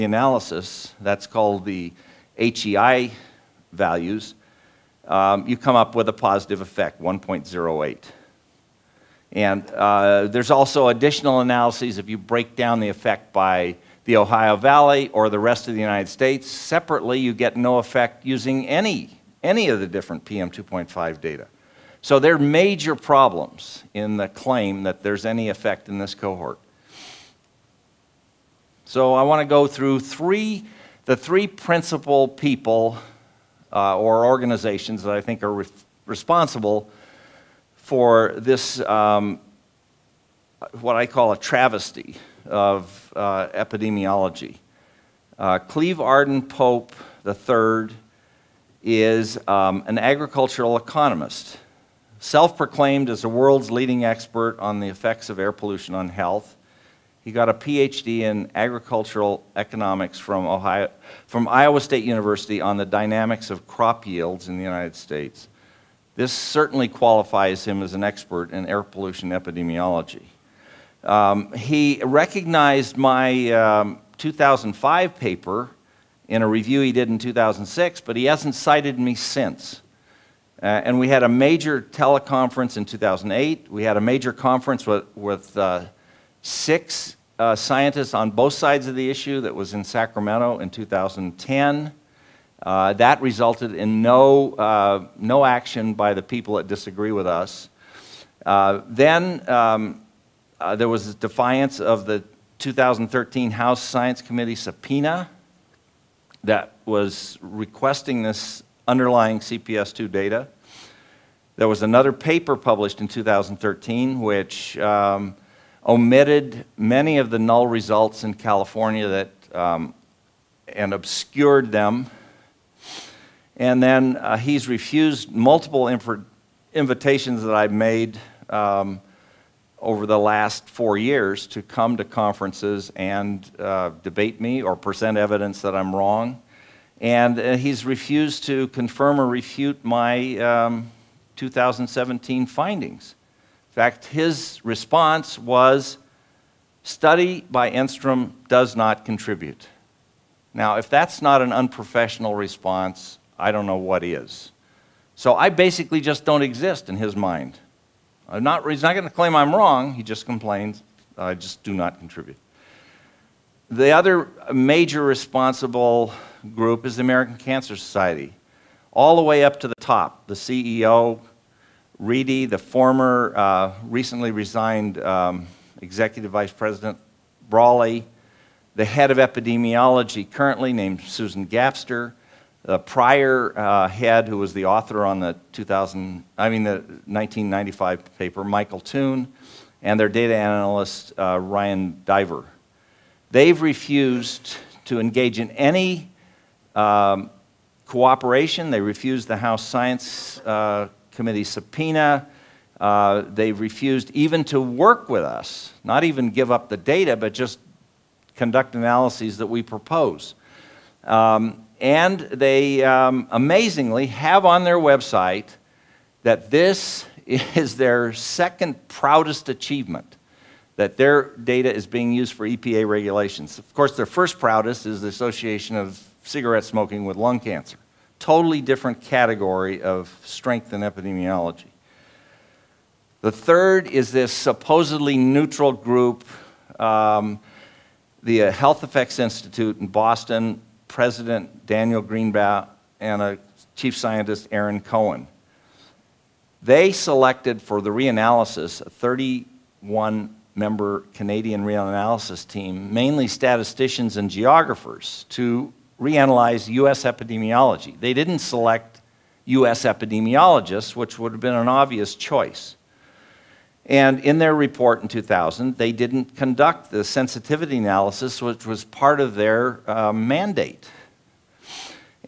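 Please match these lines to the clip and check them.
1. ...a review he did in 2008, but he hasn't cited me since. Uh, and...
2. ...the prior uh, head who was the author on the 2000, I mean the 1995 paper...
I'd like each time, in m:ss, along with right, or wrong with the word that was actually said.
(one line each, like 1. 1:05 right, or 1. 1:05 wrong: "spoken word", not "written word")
1. 1:16 wrong: "2006", not "2008"
2. 3:02 right.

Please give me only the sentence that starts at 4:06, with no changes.
They selected for the reanalysis a 31 member Canadian reanalysis team, mainly statisticians and geographers, to reanalyzed US epidemiology.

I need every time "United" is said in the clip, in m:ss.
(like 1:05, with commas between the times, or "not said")
0:15, 1:04.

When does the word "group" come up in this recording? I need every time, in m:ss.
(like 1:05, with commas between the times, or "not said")
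2:46, 3:55.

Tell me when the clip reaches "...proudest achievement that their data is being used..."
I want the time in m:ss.
3:38.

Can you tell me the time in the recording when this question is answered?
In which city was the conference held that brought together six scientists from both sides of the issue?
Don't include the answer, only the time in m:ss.
1:29.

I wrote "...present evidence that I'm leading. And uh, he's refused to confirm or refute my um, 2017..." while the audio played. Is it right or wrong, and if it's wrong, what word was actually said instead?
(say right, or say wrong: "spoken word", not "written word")
wrong: "wrong", not "leading".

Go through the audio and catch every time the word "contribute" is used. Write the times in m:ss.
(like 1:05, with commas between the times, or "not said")
2:29, 2:41.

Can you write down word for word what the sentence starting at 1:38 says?
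Uh, then um, uh, there was defiance of the 2013 House Science Committee subpoena that was requesting this underlying CPS2 data.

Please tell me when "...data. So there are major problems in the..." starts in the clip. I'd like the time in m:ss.
0:21.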